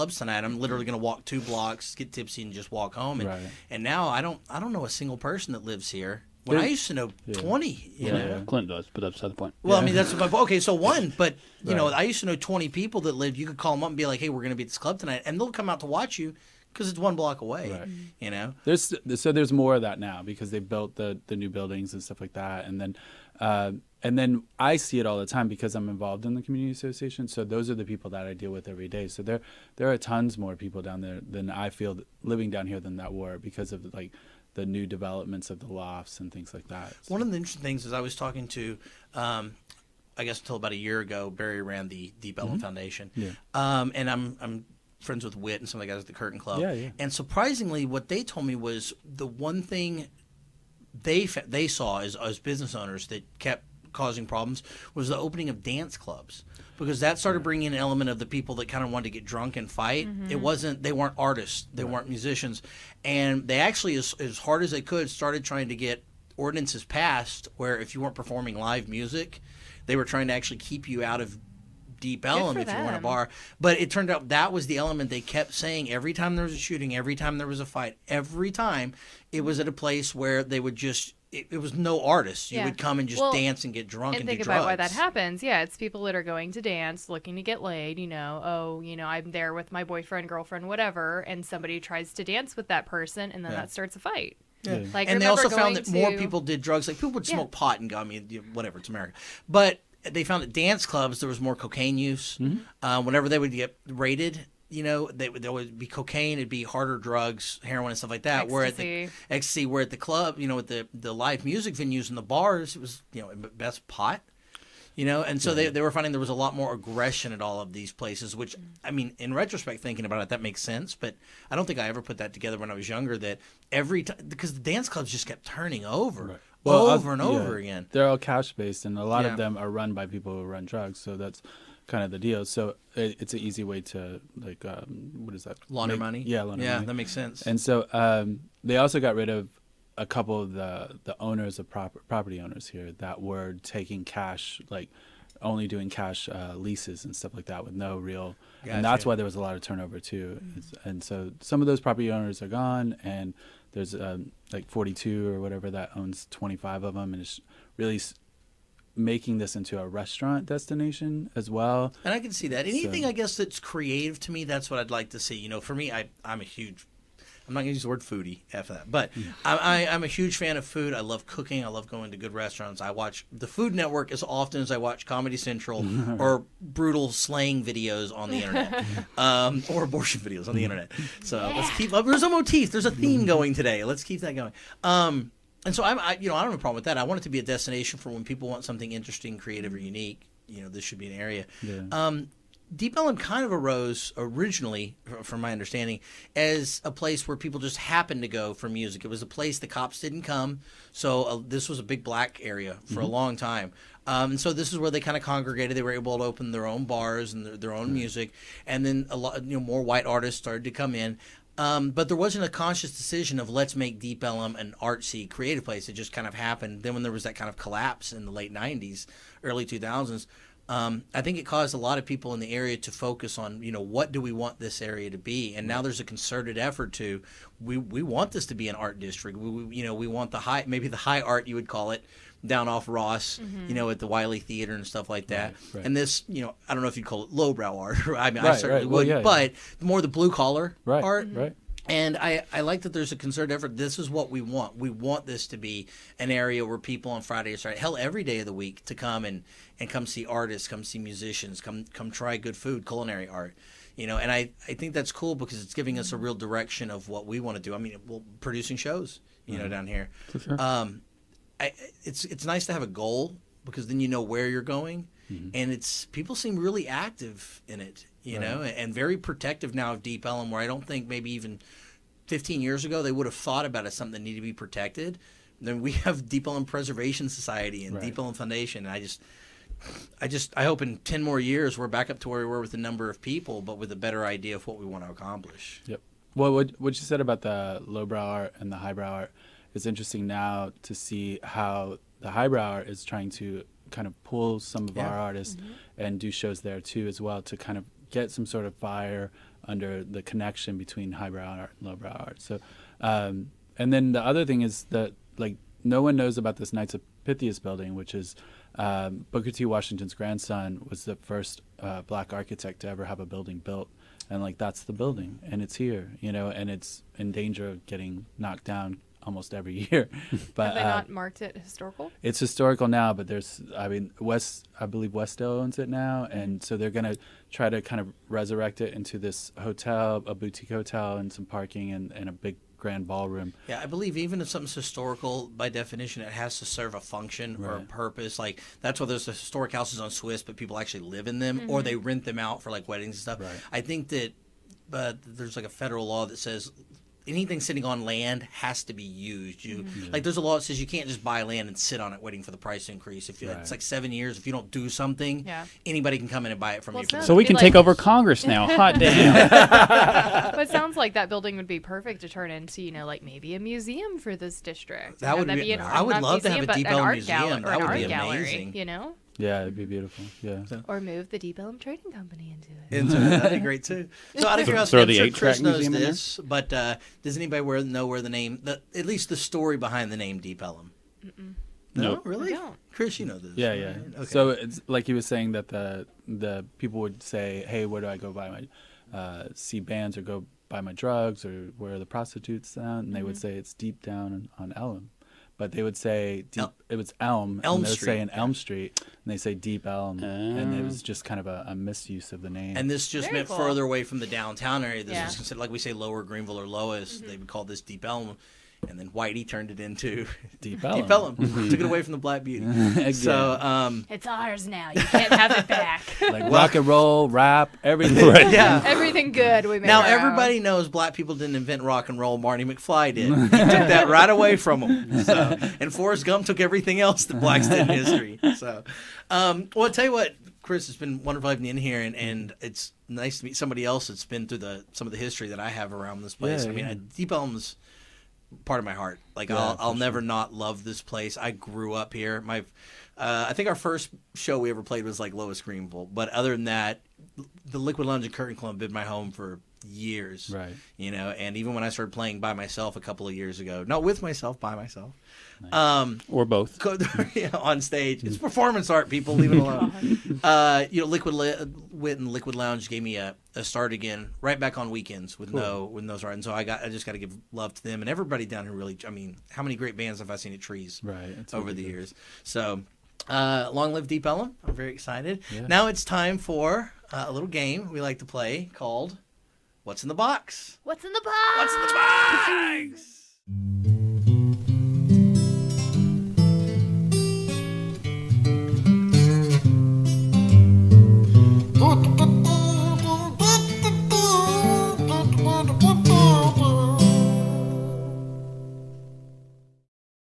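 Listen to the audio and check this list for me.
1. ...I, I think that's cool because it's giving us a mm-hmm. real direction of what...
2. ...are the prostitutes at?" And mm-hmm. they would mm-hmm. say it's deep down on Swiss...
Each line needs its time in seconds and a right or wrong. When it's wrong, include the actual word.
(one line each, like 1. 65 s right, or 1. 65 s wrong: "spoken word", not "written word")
1. 254 s right
2. 391 s wrong: "Elm", not "Swiss".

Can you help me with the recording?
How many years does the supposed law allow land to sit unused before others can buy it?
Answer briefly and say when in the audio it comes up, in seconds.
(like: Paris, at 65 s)
7, at 353 s.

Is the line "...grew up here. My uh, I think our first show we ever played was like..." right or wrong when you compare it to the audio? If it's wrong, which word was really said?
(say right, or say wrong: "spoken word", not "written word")
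right.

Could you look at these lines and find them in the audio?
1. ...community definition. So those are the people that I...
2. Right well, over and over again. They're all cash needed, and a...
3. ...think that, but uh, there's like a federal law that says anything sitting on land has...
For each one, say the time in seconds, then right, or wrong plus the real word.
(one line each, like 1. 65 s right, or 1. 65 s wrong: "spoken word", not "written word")
1. 26 s wrong: "association", not "definition"
2. 126 s wrong: "based", not "needed"
3. 343 s right.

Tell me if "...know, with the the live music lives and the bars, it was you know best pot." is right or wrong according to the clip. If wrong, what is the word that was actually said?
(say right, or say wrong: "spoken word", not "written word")
wrong: "venues", not "lives".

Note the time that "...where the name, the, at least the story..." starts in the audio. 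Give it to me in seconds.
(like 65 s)
378 s.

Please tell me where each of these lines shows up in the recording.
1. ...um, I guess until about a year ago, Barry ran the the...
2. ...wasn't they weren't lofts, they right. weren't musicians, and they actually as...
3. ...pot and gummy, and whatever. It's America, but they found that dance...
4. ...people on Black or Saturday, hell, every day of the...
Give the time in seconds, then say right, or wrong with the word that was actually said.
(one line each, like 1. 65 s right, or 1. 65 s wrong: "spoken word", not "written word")
1. 39 s right
2. 60 s wrong: "artists", not "lofts"
3. 97 s right
4. 246 s wrong: "Friday", not "Black".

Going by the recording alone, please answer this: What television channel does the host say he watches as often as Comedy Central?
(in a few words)
Food Network.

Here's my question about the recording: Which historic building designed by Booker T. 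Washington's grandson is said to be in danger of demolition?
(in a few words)
Knights of Pythias building.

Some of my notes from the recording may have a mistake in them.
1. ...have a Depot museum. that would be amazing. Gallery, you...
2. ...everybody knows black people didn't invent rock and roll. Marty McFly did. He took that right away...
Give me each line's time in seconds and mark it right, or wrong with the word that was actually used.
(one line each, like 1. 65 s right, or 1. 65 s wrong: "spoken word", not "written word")
1. 366 s right
2. 420 s right.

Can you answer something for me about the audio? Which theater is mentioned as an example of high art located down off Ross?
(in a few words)
Wyly Theater.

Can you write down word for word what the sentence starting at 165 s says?
You know, for me, I I'm a huge I'm not going to use the word foodie after that, but mm.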